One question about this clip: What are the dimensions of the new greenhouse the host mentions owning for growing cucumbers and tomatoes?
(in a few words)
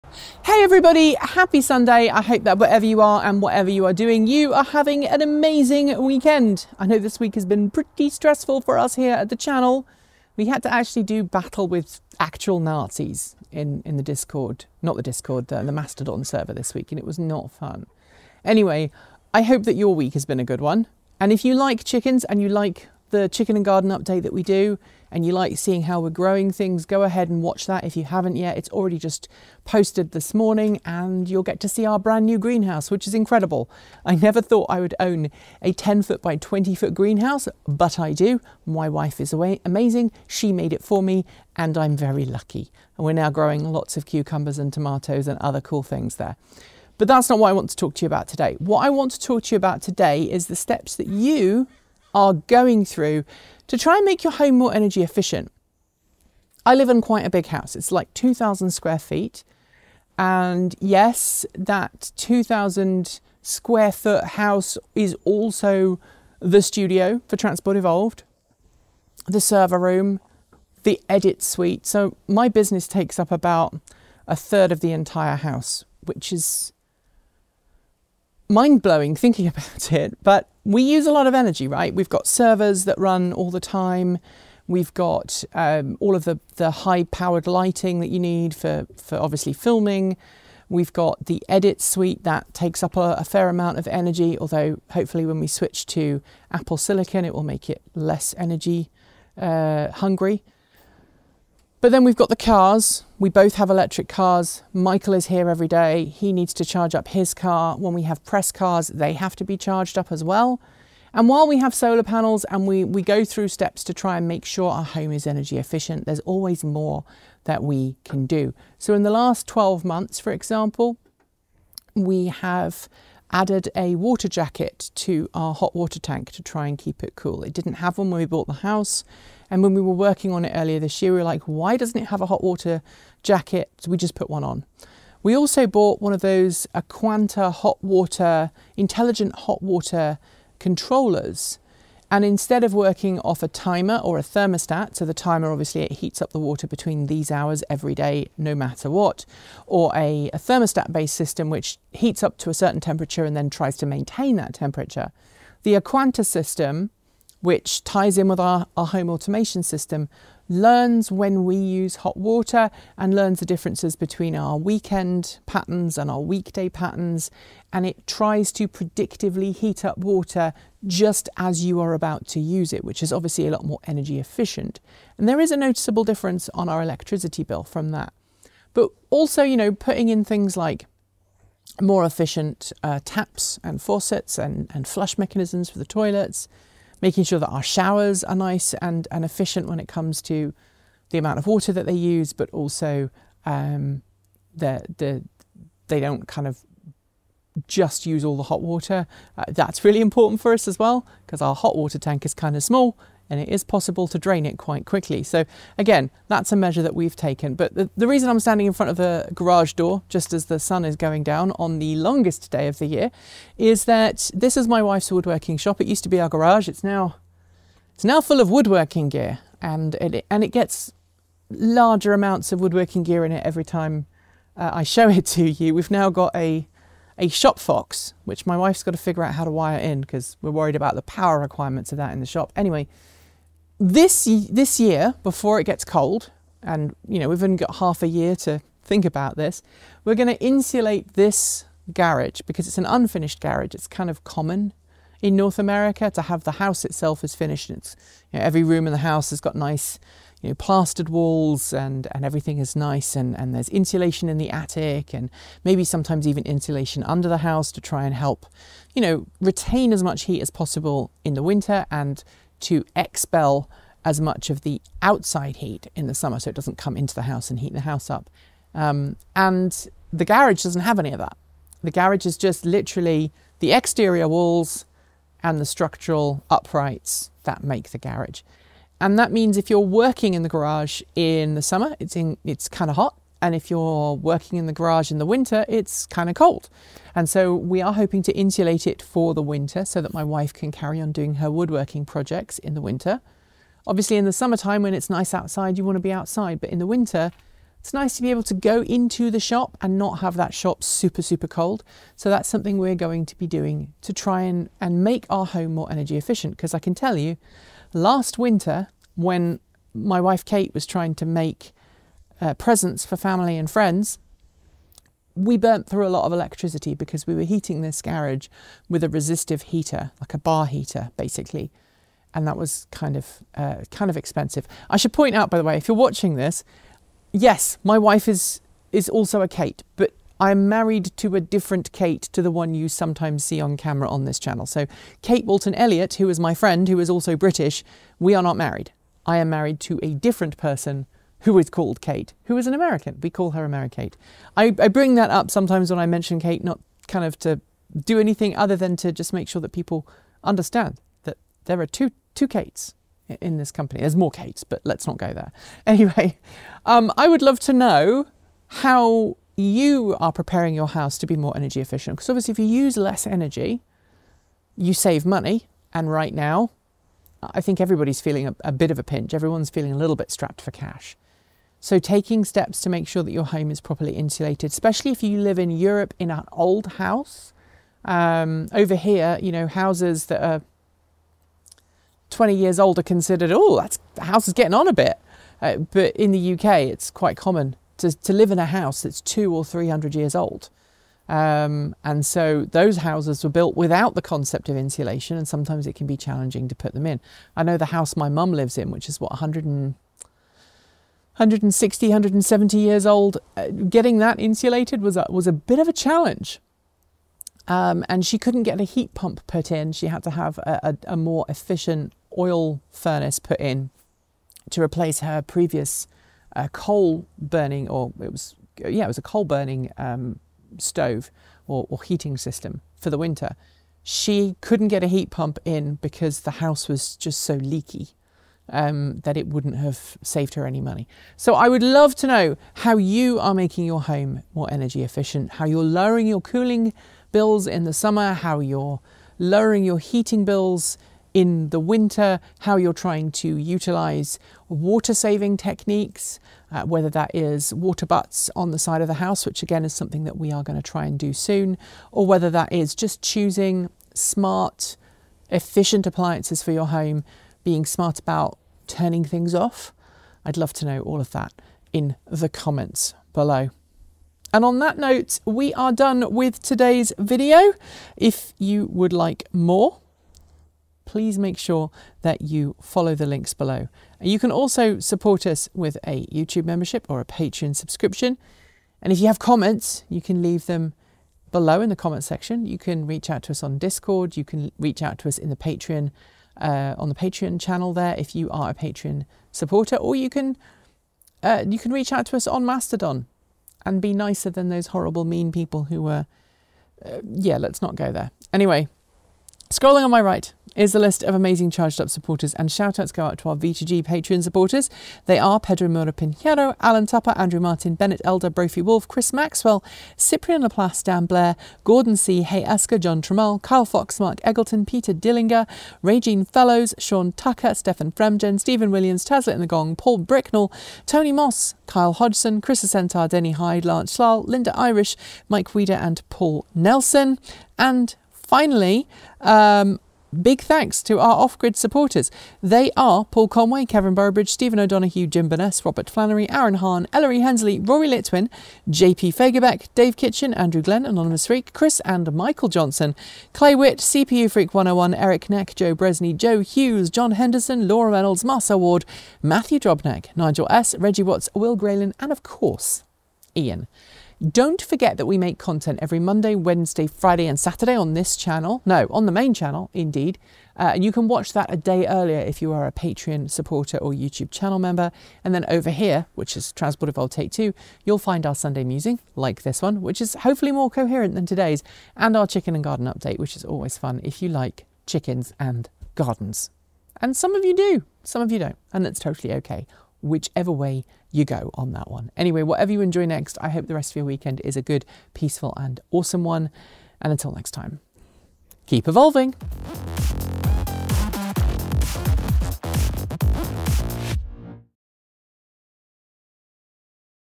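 10 feet by 20 feet.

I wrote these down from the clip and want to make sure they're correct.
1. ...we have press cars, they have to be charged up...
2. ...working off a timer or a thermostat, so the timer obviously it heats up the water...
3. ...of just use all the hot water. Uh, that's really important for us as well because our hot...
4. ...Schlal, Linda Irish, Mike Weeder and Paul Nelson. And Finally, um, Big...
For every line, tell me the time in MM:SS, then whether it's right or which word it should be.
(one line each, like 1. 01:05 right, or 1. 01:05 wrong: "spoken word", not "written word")
1. 01:47 right
2. 02:22 right
3. 03:16 right
4. 08:44 right.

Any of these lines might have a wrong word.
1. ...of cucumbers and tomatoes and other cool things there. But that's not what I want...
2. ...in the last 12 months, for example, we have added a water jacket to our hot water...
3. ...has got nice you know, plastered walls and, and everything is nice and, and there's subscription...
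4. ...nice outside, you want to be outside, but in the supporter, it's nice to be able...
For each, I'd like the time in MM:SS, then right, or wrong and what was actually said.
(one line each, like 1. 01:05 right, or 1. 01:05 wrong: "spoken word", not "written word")
1. 00:43 right
2. 01:58 right
3. 04:09 wrong: "insulation", not "subscription"
4. 04:55 wrong: "winter", not "supporter".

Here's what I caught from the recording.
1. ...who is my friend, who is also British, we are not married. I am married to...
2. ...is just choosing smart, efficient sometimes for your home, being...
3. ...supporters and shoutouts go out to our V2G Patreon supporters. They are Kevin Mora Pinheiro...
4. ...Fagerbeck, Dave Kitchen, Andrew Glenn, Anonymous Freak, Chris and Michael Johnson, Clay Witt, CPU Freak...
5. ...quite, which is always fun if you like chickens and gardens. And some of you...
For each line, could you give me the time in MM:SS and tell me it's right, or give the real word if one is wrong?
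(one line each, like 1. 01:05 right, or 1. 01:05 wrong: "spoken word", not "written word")
1. 05:36 right
2. 07:32 wrong: "appliances", not "sometimes"
3. 08:22 wrong: "Pedro", not "Kevin"
4. 08:59 right
5. 09:33 wrong: "update", not "quite".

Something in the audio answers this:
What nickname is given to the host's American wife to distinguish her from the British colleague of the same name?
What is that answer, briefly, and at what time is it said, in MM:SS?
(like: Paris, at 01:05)
Americate, at 05:43.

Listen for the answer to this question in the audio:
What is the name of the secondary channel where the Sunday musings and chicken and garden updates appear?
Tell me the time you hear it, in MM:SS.
09:26.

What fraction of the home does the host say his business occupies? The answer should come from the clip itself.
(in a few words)
a third.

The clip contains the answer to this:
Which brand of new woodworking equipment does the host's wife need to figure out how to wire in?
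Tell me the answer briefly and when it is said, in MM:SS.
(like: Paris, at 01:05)
Shop Fox, at 03:47.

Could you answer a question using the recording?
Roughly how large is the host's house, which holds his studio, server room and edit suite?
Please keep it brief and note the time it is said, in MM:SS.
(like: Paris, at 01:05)
2,000 square feet, at 00:58.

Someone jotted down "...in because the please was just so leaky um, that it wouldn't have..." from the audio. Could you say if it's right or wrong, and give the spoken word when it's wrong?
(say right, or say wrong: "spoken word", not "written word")
wrong: "house", not "please".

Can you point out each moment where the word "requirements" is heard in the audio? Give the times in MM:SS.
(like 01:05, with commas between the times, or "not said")
03:51.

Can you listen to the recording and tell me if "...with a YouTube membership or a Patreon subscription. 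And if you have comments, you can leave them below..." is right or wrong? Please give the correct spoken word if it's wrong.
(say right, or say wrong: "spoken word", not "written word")
right.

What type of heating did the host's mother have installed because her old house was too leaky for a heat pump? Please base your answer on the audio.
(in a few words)
oil furnace.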